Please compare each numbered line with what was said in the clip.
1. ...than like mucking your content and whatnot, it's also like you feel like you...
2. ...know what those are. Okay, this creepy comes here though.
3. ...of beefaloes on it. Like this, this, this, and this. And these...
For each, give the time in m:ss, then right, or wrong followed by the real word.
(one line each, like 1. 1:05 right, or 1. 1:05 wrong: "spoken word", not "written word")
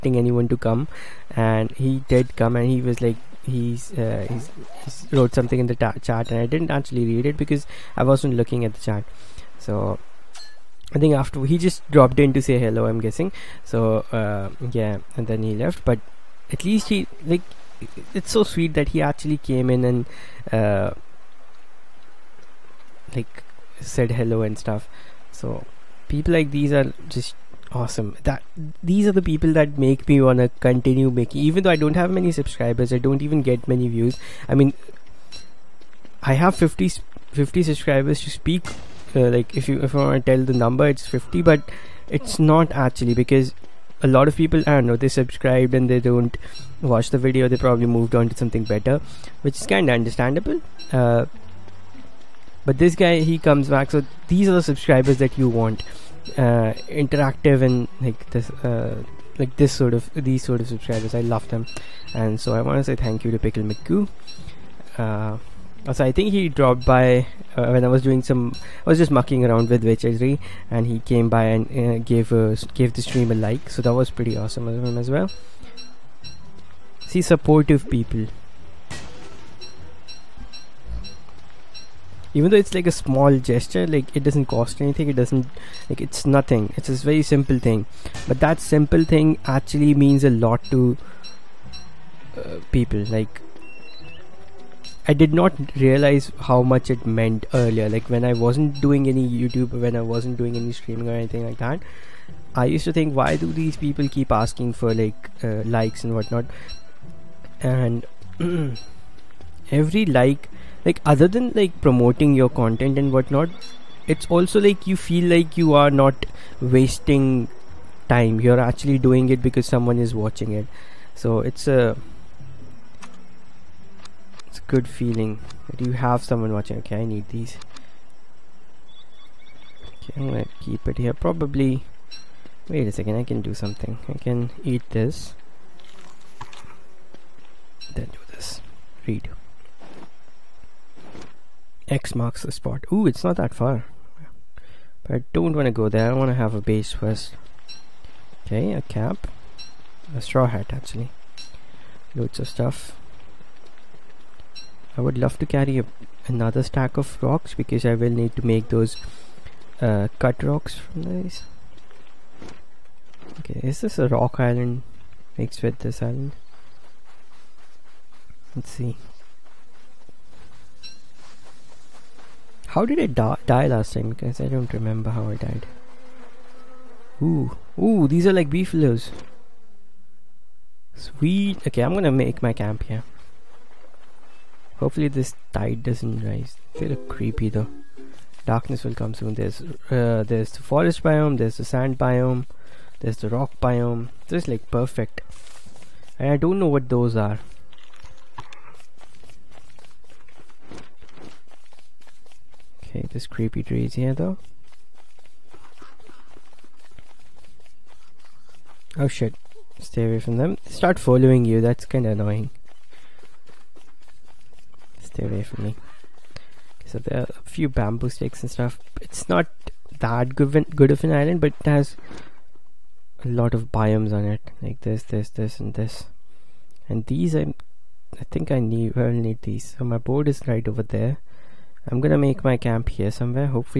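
1. 1:51 wrong: "promoting", not "mucking"
2. 3:16 wrong: "trees", not "comes"
3. 3:43 wrong: "biomes", not "beefaloes".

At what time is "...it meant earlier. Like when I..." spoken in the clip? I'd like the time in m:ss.
1:36.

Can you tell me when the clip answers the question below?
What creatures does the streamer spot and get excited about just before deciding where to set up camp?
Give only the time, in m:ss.
2:58.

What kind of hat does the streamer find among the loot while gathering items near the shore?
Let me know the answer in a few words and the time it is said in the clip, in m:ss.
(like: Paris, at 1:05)
A straw hat, at 2:30.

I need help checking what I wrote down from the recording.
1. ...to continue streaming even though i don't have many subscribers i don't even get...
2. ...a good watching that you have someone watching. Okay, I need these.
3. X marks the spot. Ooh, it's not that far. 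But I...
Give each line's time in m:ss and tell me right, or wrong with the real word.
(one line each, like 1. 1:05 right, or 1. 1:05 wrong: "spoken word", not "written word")
1. 0:30 wrong: "making", not "streaming"
2. 2:04 wrong: "feeling", not "watching"
3. 2:21 right.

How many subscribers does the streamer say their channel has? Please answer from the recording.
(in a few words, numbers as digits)
50.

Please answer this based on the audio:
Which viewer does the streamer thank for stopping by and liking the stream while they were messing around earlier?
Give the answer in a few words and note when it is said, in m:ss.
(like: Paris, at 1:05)
Pickle McGoo, at 1:03.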